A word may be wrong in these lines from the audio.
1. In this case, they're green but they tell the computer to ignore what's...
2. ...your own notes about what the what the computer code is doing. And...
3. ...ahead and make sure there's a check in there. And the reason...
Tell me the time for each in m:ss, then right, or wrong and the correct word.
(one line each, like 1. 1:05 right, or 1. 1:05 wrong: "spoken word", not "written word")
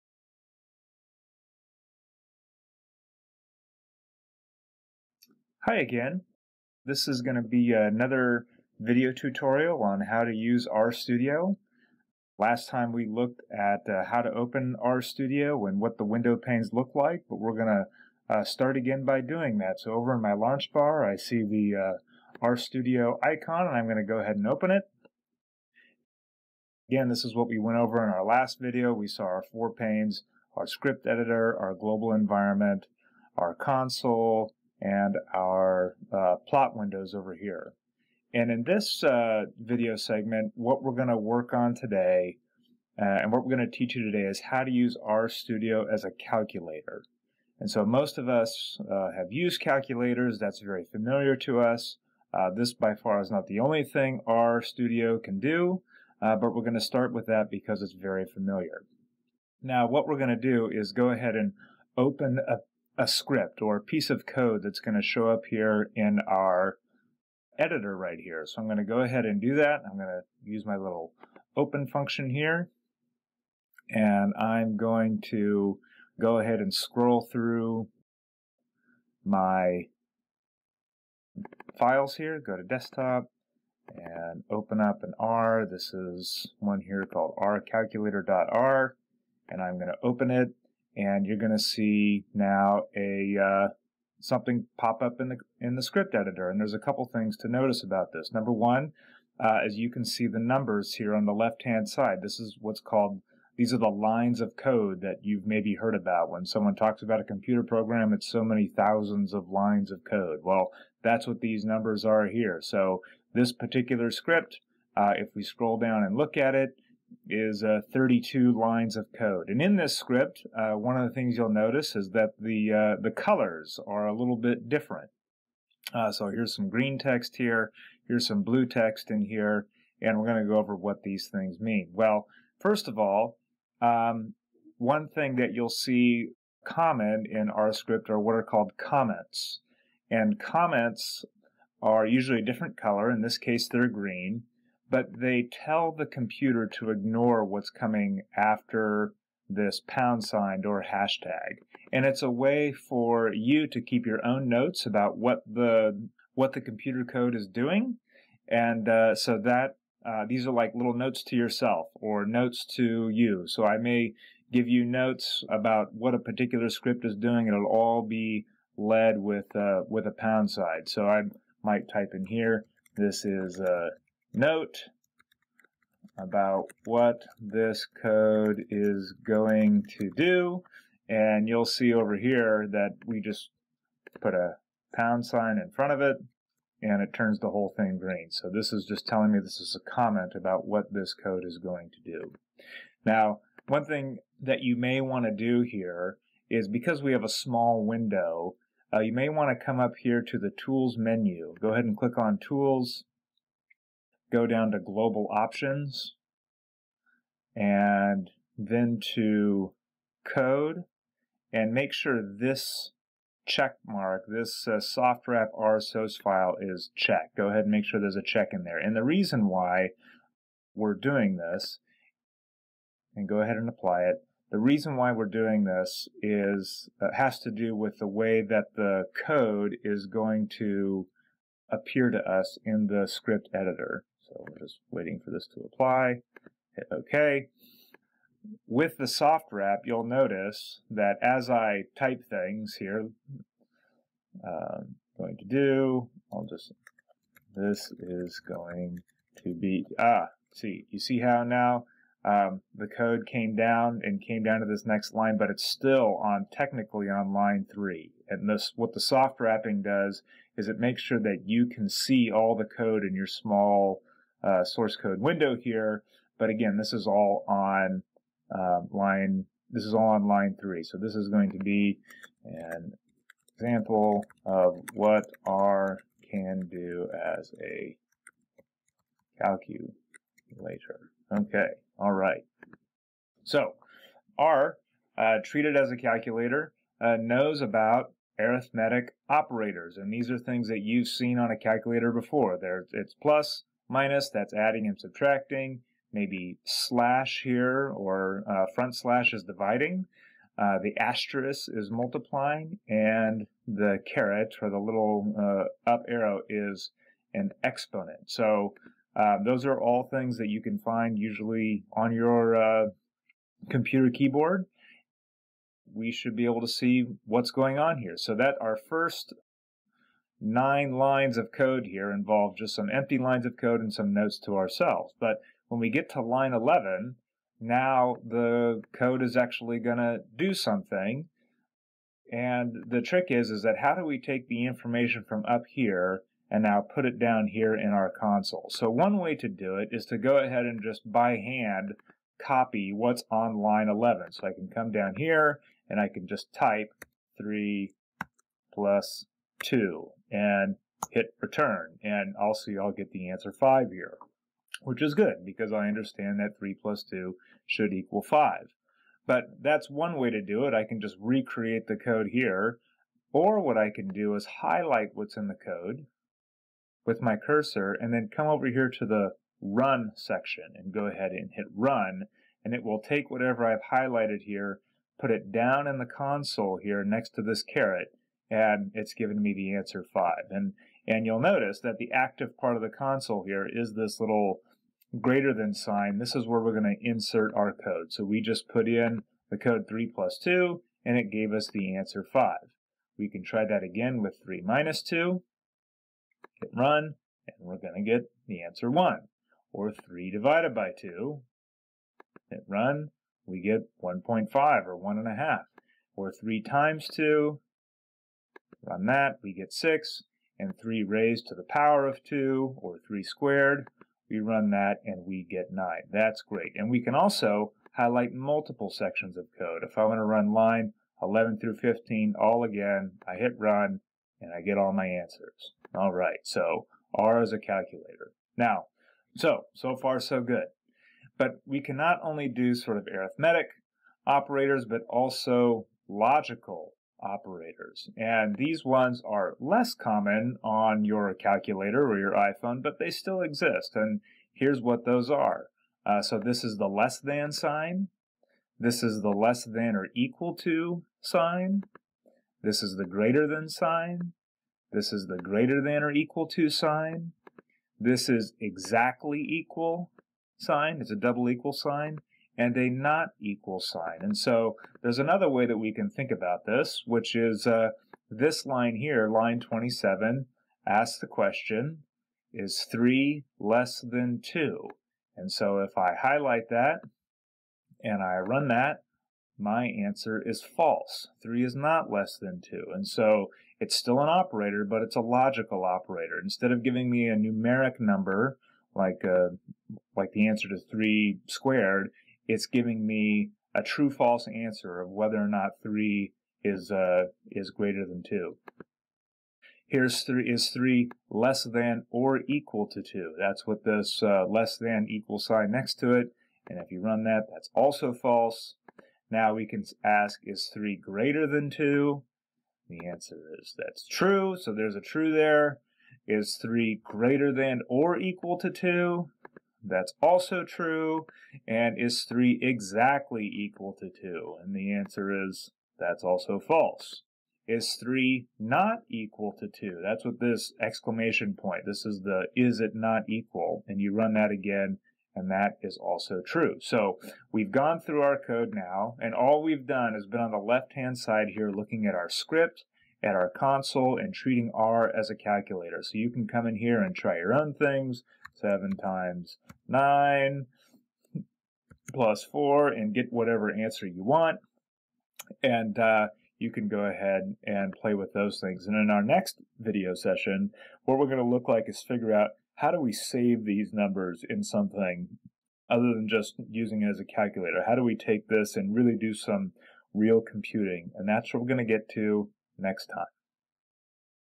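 1. 2:23 right
2. 2:34 right
3. 3:37 right.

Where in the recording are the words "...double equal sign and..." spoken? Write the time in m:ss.
7:41.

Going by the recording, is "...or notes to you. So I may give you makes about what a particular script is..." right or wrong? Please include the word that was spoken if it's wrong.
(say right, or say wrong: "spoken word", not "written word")
wrong: "notes", not "makes".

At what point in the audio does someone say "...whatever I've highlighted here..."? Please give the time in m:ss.
6:13.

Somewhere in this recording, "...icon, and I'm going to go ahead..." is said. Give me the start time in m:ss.
0:23.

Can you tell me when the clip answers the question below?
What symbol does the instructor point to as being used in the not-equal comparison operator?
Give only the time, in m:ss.
8:50.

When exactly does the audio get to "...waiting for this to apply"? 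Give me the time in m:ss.
3:54.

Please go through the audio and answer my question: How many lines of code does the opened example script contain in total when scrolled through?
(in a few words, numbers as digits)
32.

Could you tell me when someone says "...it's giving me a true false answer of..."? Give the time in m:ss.
8:12.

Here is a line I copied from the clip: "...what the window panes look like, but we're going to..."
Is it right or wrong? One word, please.
right.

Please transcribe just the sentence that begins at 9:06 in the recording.
So you can come in here and try your own things, 7 times 9 plus 4 and get whatever answer you want.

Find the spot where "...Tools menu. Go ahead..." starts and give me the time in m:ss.
3:20.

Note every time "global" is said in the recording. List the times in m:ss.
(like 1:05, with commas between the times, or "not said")
0:31, 3:24.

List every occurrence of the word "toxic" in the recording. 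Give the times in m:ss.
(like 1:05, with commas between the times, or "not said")
not said.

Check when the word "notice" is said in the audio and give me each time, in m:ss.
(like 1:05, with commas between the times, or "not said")
1:37, 2:01, 4:00, 6:21.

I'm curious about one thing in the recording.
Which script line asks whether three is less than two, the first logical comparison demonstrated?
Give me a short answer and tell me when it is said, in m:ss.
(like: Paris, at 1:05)
Line 27, at 7:49.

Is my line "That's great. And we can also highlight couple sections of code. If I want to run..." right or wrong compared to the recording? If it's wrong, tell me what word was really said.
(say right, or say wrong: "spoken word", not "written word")
wrong: "multiple", not "couple".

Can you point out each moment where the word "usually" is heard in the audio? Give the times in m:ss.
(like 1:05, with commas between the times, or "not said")
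2:22, 5:11.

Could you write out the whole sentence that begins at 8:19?
Here's three is three less than or equal to two.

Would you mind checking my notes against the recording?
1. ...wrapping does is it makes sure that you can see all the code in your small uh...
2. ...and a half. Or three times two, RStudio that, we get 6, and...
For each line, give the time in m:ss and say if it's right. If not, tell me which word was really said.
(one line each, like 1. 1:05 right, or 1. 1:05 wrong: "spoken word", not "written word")
1. 4:19 right
2. 6:45 wrong: "Run", not "RStudio".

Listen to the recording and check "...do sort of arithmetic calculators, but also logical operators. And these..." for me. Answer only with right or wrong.
wrong.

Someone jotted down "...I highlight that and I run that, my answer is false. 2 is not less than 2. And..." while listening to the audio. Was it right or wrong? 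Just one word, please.
wrong.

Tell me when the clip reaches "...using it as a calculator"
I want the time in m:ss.
9:26.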